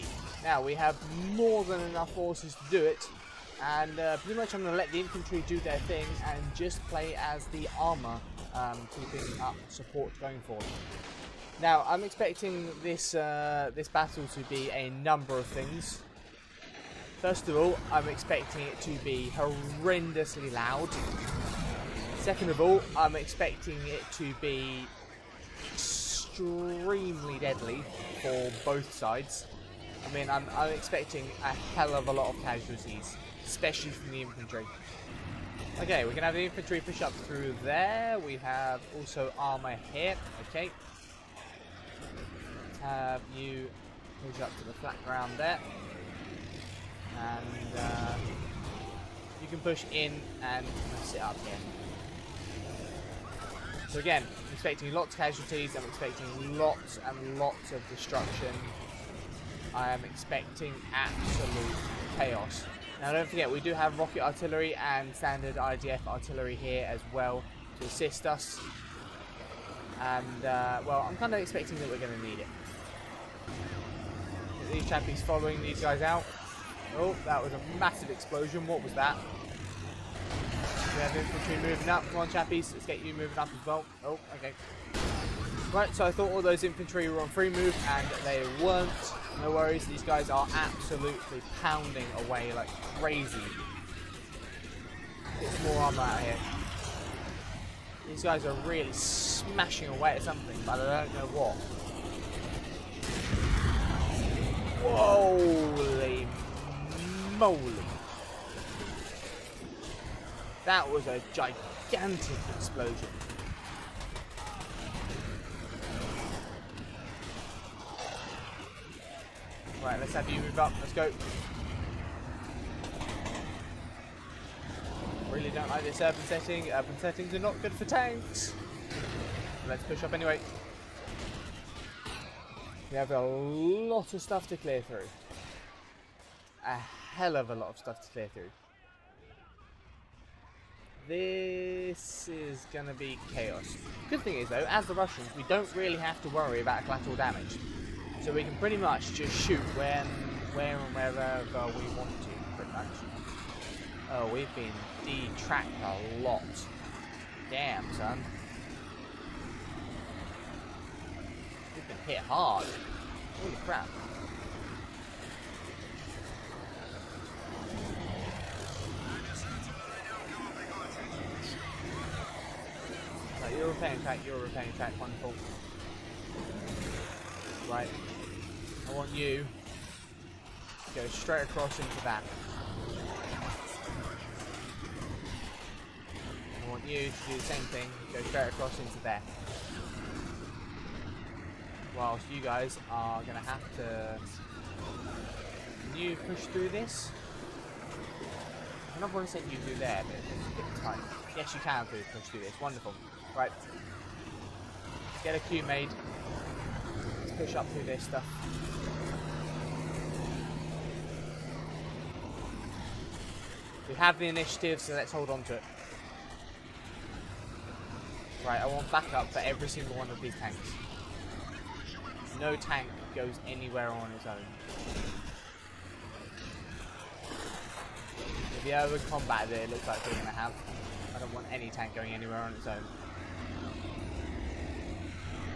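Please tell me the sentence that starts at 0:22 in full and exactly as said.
Second of all, I'm expecting it to be extremely deadly for both sides.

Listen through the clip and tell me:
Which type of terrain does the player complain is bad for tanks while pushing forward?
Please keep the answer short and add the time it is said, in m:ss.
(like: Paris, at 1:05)
Urban settings, at 2:06.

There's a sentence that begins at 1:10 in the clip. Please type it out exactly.
And, uh, well, I'm kind of expecting that we're going to need it.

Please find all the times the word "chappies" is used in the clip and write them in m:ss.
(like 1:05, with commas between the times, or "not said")
1:14, 1:22.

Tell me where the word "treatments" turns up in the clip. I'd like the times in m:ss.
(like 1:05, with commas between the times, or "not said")
not said.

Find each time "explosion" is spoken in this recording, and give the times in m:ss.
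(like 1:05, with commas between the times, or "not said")
1:18, 1:52.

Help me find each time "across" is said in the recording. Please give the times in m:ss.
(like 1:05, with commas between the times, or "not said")
3:01, 3:08.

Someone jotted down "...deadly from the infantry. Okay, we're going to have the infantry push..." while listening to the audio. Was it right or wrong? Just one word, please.
wrong.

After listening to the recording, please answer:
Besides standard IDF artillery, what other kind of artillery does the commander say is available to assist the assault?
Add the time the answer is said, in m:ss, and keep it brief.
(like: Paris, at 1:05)
Rocket artillery, at 1:03.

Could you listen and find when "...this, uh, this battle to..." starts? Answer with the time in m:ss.
0:12.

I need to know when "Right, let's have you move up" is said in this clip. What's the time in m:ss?
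1:59.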